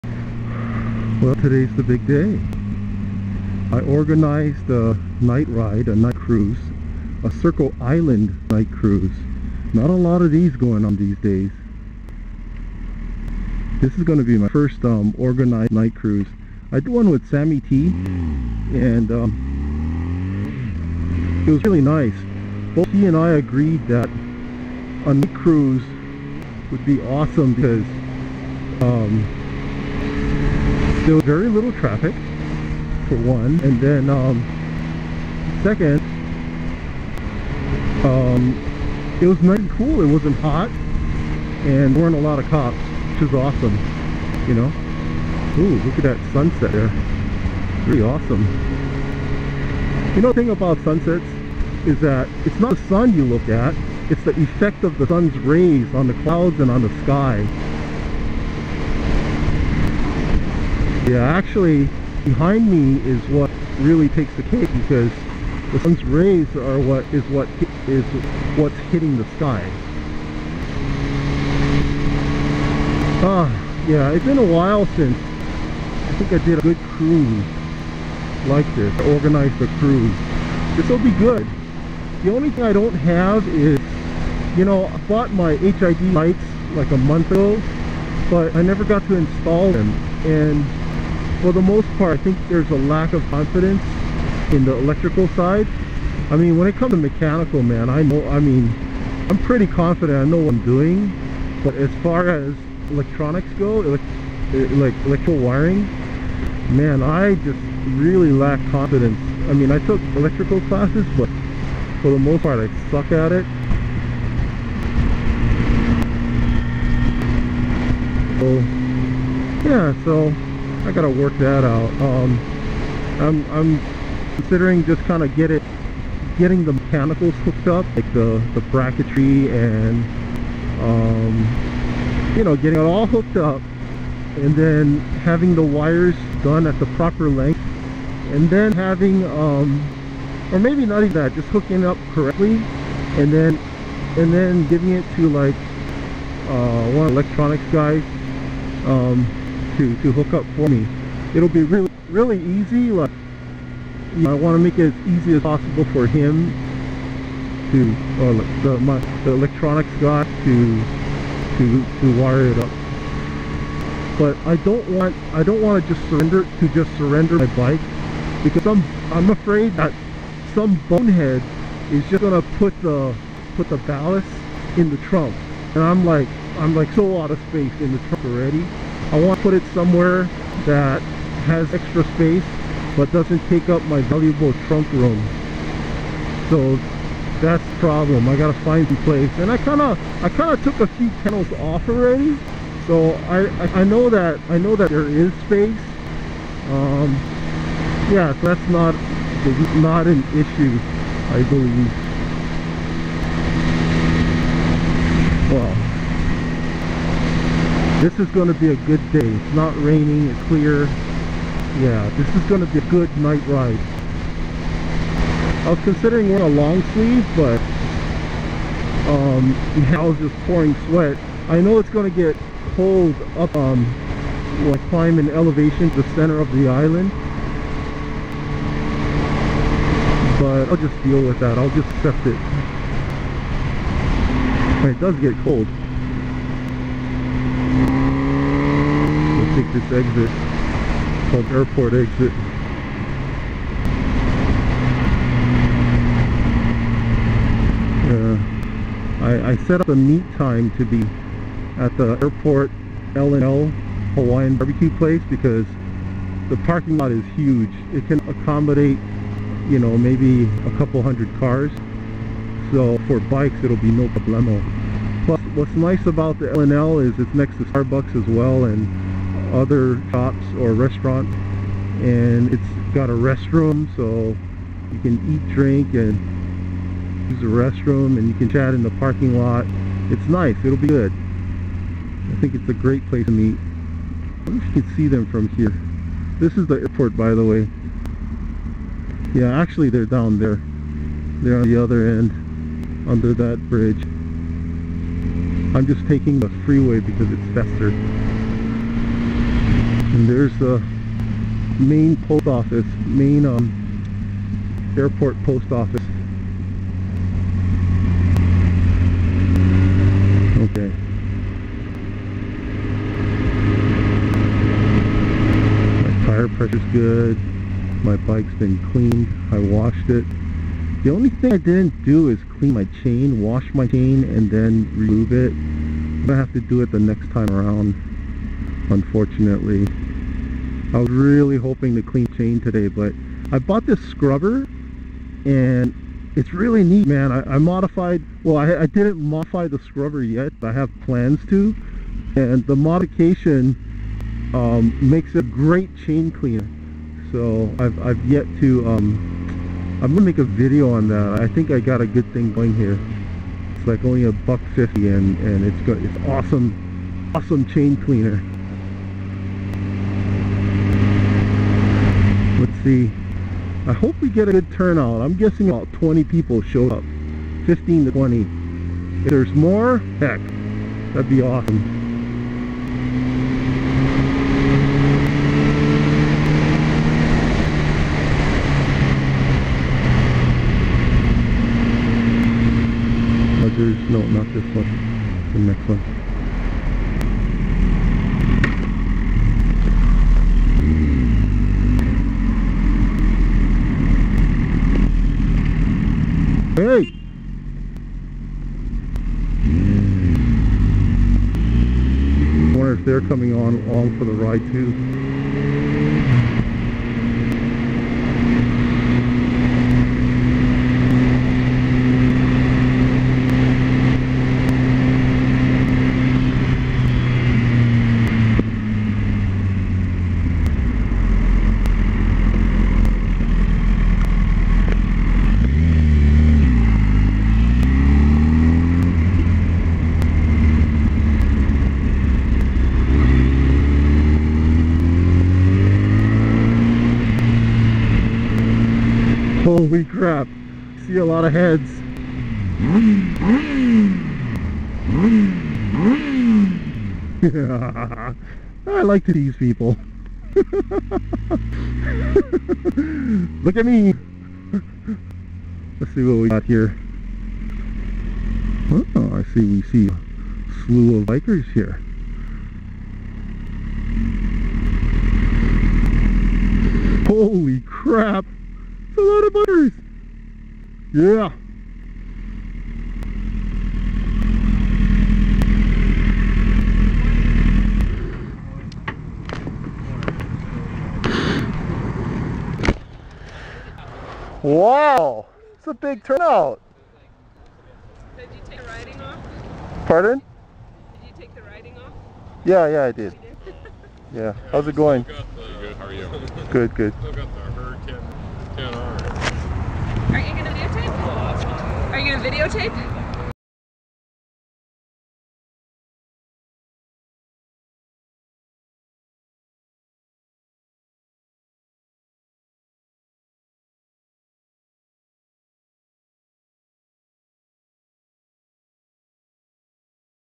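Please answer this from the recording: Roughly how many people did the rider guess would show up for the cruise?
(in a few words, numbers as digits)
about 20.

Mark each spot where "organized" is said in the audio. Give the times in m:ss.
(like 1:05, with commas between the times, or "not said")
0:03, 0:15, 1:19.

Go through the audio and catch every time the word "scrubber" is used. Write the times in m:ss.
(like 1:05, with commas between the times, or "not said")
5:34, 5:39.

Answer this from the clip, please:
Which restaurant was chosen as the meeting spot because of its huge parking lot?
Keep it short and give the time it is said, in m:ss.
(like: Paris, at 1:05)
L&L Hawaiian Barbecue, at 4:13.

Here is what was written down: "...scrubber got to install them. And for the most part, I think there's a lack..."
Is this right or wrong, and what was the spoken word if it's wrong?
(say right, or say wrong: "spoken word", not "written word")
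wrong: "never", not "scrubber".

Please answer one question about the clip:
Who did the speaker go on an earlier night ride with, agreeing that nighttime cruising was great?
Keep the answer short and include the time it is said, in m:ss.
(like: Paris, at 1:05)
Sammy T, at 0:17.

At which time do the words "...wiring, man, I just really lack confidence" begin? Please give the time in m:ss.
1:45.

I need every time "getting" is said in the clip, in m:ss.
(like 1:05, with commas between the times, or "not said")
2:06, 2:12.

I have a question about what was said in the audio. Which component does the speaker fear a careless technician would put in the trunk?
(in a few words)
the ballast.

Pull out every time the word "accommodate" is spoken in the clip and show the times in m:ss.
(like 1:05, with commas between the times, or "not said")
4:18.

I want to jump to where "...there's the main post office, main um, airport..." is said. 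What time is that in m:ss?
5:00.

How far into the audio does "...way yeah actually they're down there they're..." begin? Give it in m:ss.
4:47.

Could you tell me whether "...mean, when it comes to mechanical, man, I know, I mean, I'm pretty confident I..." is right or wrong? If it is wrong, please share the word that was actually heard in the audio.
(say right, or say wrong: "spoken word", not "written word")
right.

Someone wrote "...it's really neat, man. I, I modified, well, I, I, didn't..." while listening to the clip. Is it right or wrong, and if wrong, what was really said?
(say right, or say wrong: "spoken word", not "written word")
right.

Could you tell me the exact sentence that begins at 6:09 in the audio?
If there's more, heck, that'd be awesome.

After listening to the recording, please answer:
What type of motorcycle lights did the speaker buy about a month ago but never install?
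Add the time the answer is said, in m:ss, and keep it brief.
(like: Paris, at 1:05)
HID lights, at 1:25.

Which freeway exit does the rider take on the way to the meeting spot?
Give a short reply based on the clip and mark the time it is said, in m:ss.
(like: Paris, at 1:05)
airport exit, at 4:01.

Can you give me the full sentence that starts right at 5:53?
It's like only a buck fifty and, and it's, got, it's awesome, awesome chain cleaner.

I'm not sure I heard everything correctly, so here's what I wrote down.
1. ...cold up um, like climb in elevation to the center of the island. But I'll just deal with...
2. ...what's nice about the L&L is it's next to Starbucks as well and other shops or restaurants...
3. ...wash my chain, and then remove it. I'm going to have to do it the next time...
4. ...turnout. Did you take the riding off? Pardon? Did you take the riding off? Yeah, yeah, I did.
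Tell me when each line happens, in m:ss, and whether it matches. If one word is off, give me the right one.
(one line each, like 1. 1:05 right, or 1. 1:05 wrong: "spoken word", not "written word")
1. 3:42 right
2. 4:25 right
3. 5:23 right
4. 8:06 right.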